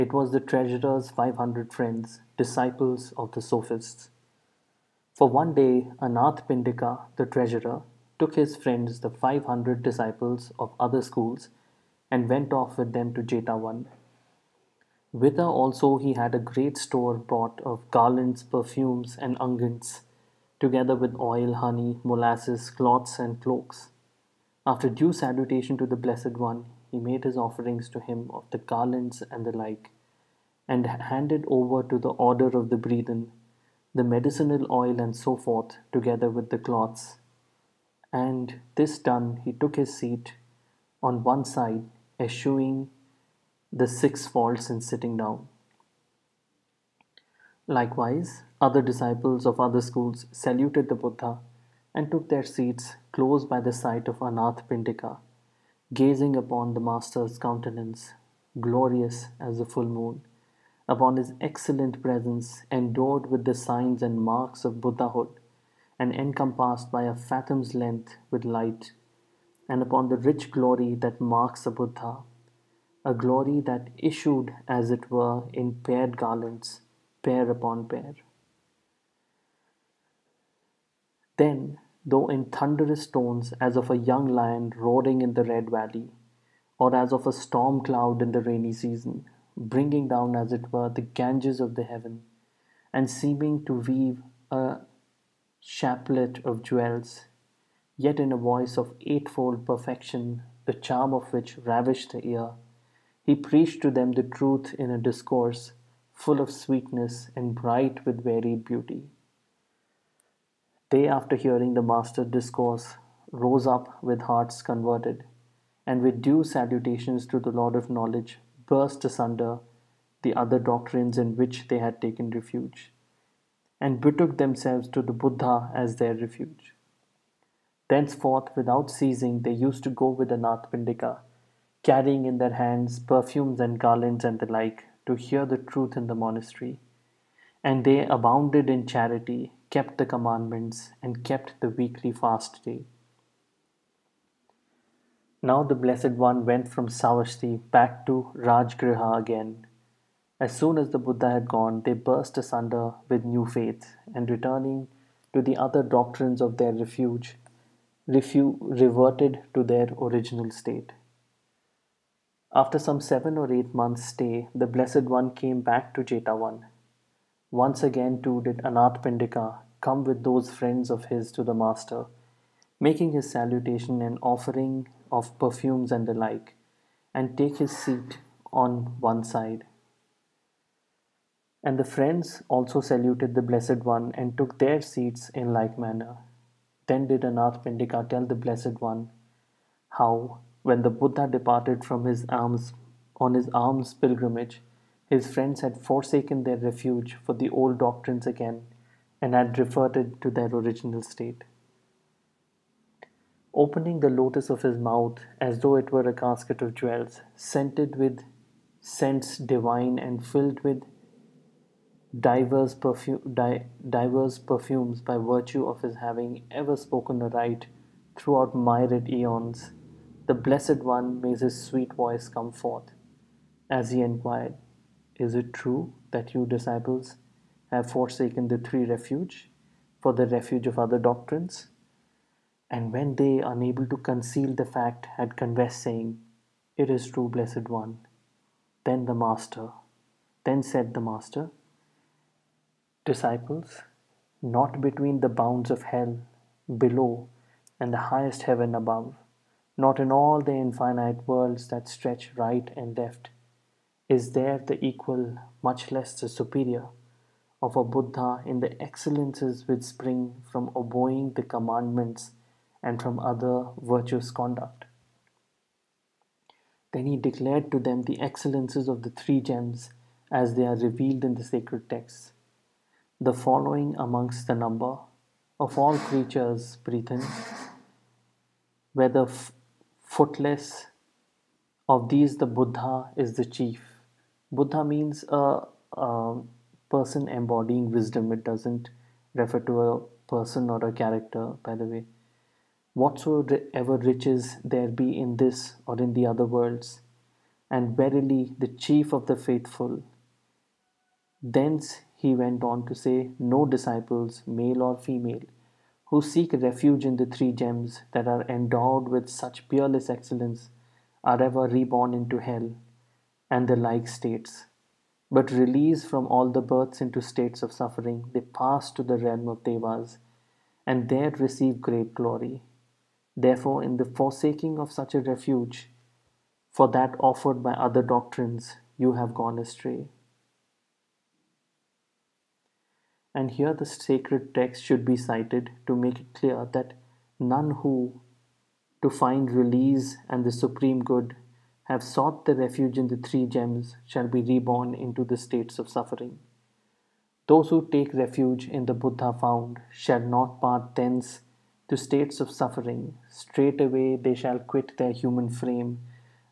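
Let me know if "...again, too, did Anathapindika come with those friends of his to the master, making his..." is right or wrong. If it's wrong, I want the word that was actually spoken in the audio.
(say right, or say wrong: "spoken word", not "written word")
right.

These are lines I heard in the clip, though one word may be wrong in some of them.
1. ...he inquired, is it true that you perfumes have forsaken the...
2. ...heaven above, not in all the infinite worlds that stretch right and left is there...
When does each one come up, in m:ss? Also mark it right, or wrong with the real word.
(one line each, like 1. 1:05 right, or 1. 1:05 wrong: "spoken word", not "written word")
1. 3:43 wrong: "disciples", not "perfumes"
2. 4:08 right.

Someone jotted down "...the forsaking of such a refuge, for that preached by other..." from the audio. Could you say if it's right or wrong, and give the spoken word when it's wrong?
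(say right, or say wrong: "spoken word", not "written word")
wrong: "offered", not "preached".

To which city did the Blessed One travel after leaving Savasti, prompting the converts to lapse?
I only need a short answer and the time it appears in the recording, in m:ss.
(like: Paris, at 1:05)
Rajgriha, at 2:28.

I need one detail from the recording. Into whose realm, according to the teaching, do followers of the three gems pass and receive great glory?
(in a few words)
Devas.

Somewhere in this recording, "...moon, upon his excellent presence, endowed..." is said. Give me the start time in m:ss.
0:59.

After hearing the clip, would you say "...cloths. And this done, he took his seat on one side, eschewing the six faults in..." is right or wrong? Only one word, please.
right.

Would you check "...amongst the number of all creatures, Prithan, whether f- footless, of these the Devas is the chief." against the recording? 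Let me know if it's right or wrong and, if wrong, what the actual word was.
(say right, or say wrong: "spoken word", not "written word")
wrong: "Buddha", not "Devas".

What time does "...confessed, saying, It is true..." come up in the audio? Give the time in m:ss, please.
3:55.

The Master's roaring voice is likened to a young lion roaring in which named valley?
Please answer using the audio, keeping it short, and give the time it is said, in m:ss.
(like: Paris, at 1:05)
Red Valley, at 1:25.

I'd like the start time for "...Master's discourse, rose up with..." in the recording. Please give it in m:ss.
1:51.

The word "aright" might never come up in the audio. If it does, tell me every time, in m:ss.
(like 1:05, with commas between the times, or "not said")
3:37.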